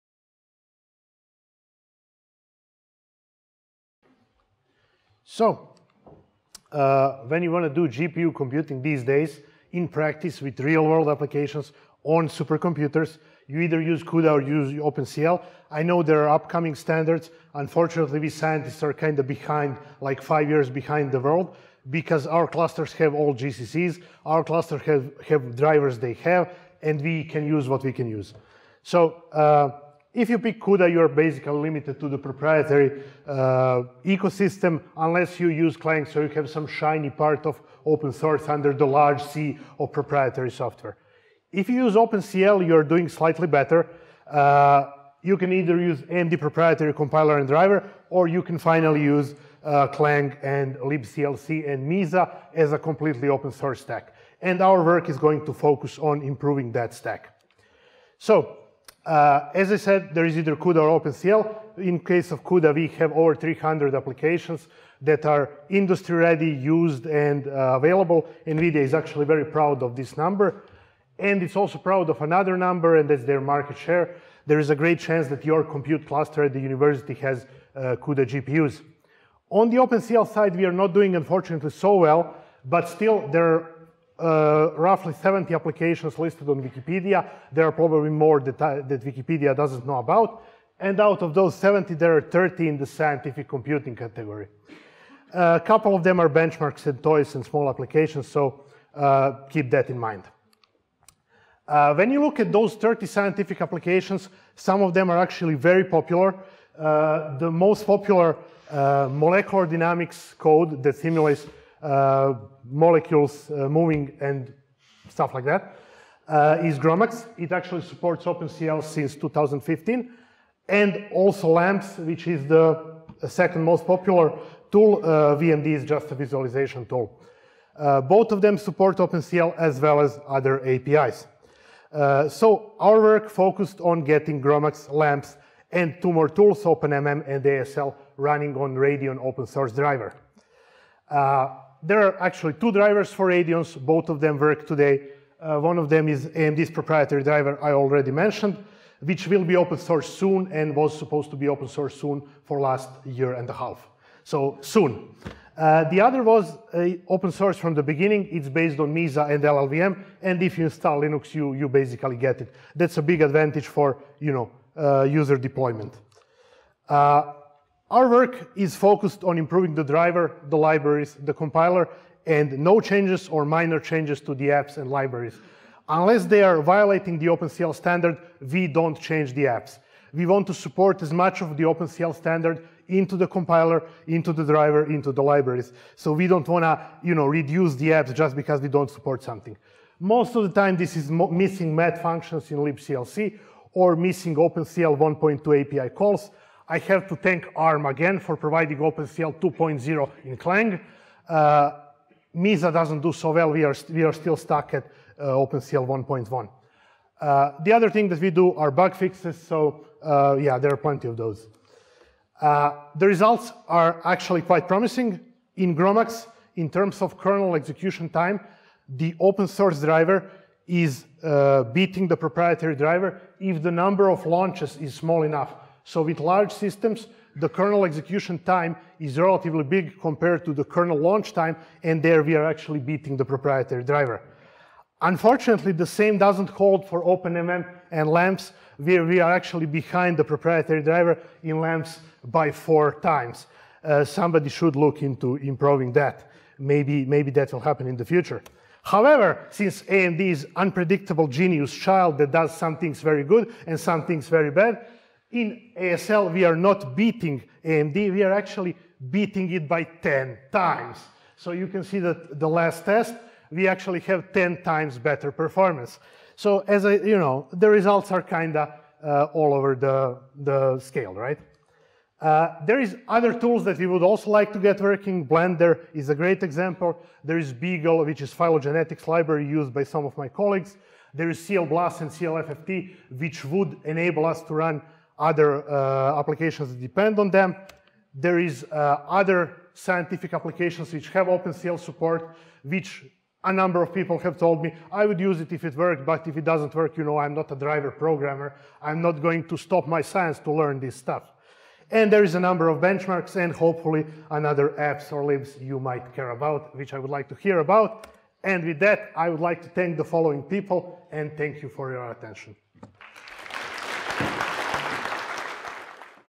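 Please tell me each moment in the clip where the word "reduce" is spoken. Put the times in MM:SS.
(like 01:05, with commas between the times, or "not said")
03:07.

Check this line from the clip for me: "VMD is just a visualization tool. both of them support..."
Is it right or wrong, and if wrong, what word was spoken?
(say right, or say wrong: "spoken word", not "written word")
right.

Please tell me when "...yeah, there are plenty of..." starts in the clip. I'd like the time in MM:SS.
03:30.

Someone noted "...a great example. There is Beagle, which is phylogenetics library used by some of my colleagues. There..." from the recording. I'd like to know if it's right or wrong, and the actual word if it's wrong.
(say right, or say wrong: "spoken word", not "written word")
right.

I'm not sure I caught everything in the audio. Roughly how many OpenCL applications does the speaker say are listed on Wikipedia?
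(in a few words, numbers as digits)
70.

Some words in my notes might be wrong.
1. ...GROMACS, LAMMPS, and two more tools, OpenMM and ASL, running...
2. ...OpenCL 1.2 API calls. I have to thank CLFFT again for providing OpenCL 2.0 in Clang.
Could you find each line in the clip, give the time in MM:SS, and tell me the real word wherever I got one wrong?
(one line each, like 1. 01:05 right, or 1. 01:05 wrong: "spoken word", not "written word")
1. 02:14 right
2. 03:14 wrong: "ARM", not "CLFFT".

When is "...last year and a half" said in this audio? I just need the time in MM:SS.
02:32.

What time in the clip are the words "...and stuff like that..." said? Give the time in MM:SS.
01:54.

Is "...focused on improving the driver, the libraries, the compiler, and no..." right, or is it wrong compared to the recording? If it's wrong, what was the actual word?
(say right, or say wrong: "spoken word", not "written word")
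right.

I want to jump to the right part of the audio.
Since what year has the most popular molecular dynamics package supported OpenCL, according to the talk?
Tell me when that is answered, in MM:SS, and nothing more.
01:59.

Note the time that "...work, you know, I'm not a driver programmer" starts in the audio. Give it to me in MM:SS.
04:56.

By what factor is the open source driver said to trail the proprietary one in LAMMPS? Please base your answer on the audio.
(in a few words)
4 times.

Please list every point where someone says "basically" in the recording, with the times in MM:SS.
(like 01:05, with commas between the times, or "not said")
00:31, 02:41.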